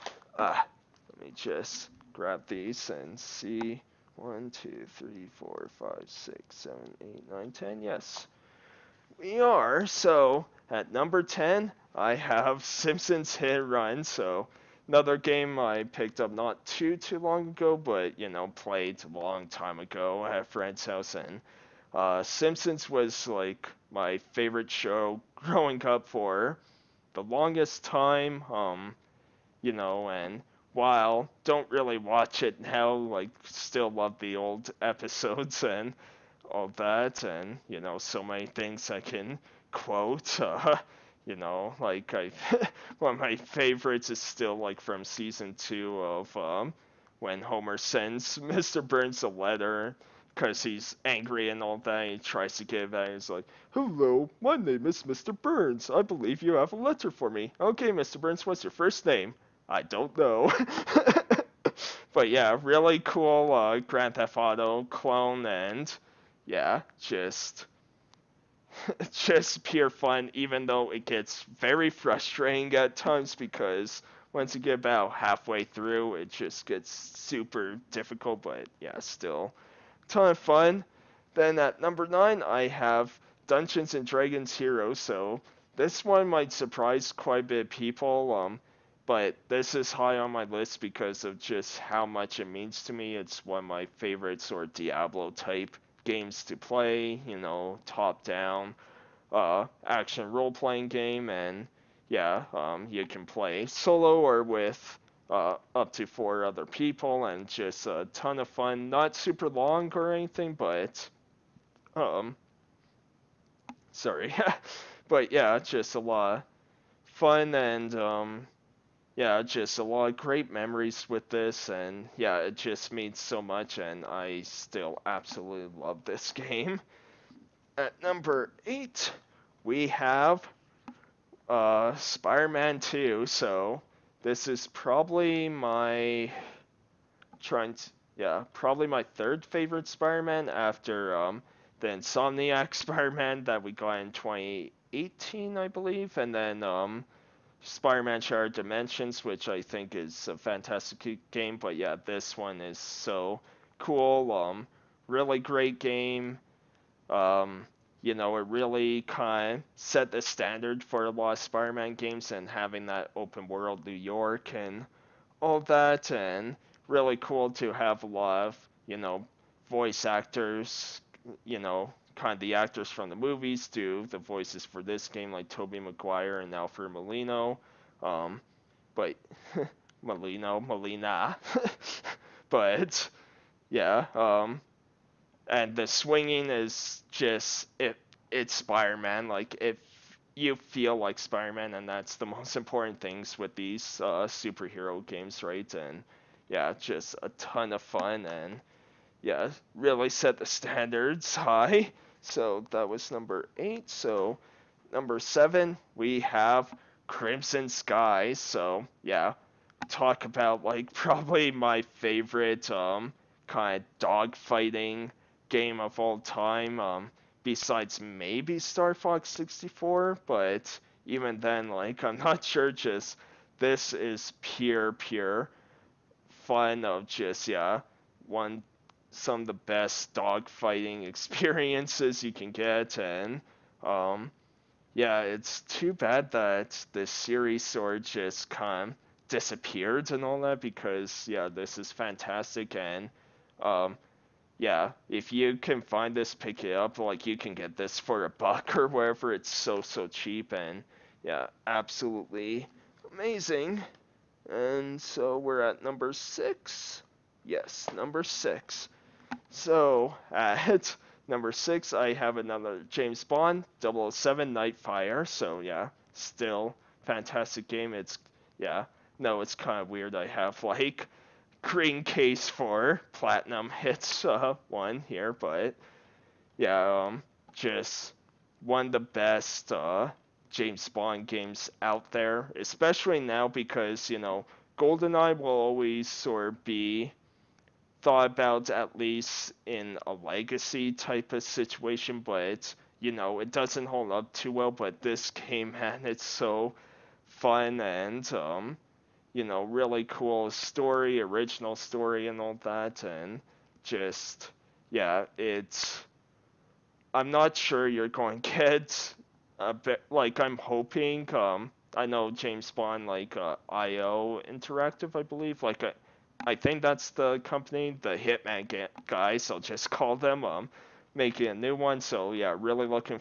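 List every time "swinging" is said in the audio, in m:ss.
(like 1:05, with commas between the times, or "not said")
3:05.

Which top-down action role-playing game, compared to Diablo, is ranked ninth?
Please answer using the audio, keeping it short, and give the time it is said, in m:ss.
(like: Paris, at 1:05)
Dungeons and Dragons Heroes, at 1:23.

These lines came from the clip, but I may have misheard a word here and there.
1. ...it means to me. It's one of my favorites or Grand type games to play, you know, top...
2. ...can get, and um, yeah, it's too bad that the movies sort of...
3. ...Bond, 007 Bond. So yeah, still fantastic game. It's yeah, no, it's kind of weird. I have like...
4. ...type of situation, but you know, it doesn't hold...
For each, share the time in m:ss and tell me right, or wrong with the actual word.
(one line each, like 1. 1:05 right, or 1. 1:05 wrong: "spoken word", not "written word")
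1. 1:32 wrong: "Diablo", not "Grand"
2. 3:52 wrong: "series", not "movies"
3. 4:23 wrong: "Nightfire", not "Bond"
4. 4:50 right.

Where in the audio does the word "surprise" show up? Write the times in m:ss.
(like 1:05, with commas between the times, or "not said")
1:26.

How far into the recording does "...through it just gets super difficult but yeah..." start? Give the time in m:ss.
1:15.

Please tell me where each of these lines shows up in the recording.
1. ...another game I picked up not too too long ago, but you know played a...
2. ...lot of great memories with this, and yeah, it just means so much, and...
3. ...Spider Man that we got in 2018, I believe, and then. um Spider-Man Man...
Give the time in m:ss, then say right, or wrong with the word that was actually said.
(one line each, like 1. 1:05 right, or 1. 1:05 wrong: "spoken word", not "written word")
1. 0:14 right
2. 1:59 right
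3. 2:22 wrong: "Shattered", not "Man".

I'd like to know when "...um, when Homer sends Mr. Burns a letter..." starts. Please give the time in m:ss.
0:46.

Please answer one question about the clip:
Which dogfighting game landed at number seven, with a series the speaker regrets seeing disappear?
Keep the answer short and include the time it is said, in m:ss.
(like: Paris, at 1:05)
Crimson Skies, at 3:27.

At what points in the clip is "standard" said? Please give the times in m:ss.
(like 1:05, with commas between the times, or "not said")
2:40, 3:20.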